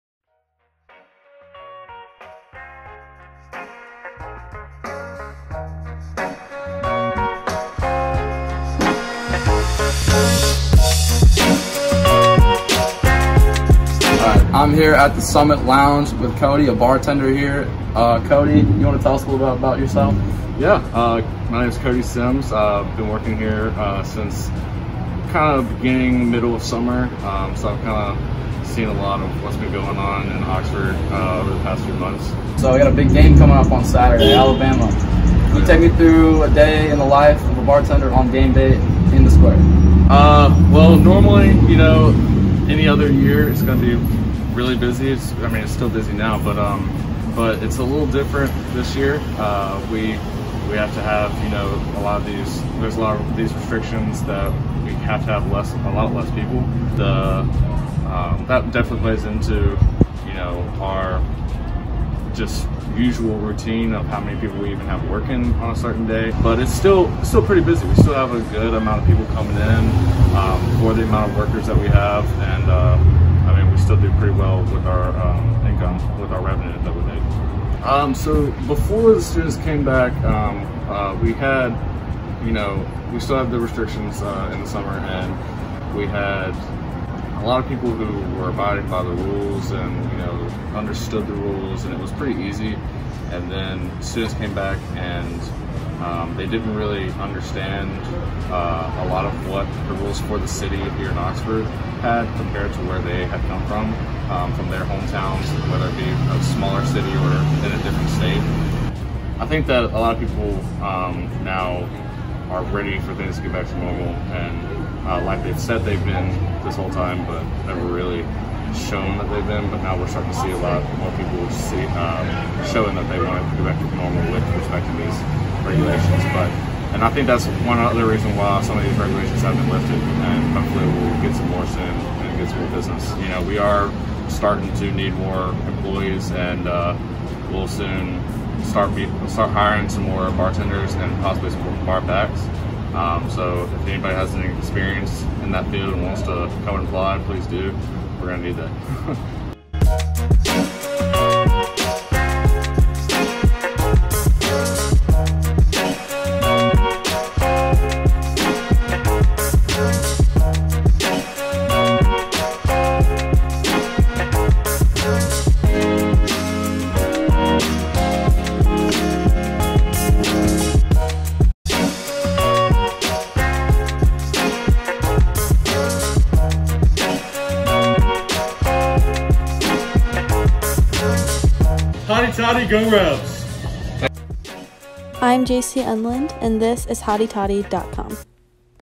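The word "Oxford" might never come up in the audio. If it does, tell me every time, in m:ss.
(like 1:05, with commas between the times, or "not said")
0:30, 1:41.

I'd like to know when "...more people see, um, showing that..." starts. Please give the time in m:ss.
2:00.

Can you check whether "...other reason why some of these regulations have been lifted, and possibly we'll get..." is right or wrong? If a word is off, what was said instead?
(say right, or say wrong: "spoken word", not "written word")
wrong: "hopefully", not "possibly".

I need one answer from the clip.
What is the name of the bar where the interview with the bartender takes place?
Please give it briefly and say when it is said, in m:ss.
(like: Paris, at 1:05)
Summit Lounge, at 0:15.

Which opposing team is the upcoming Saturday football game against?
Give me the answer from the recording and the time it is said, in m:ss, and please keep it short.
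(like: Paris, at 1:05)
Alabama, at 0:34.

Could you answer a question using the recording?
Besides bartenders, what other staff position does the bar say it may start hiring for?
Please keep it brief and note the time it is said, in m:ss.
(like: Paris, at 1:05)
Bar backs, at 2:21.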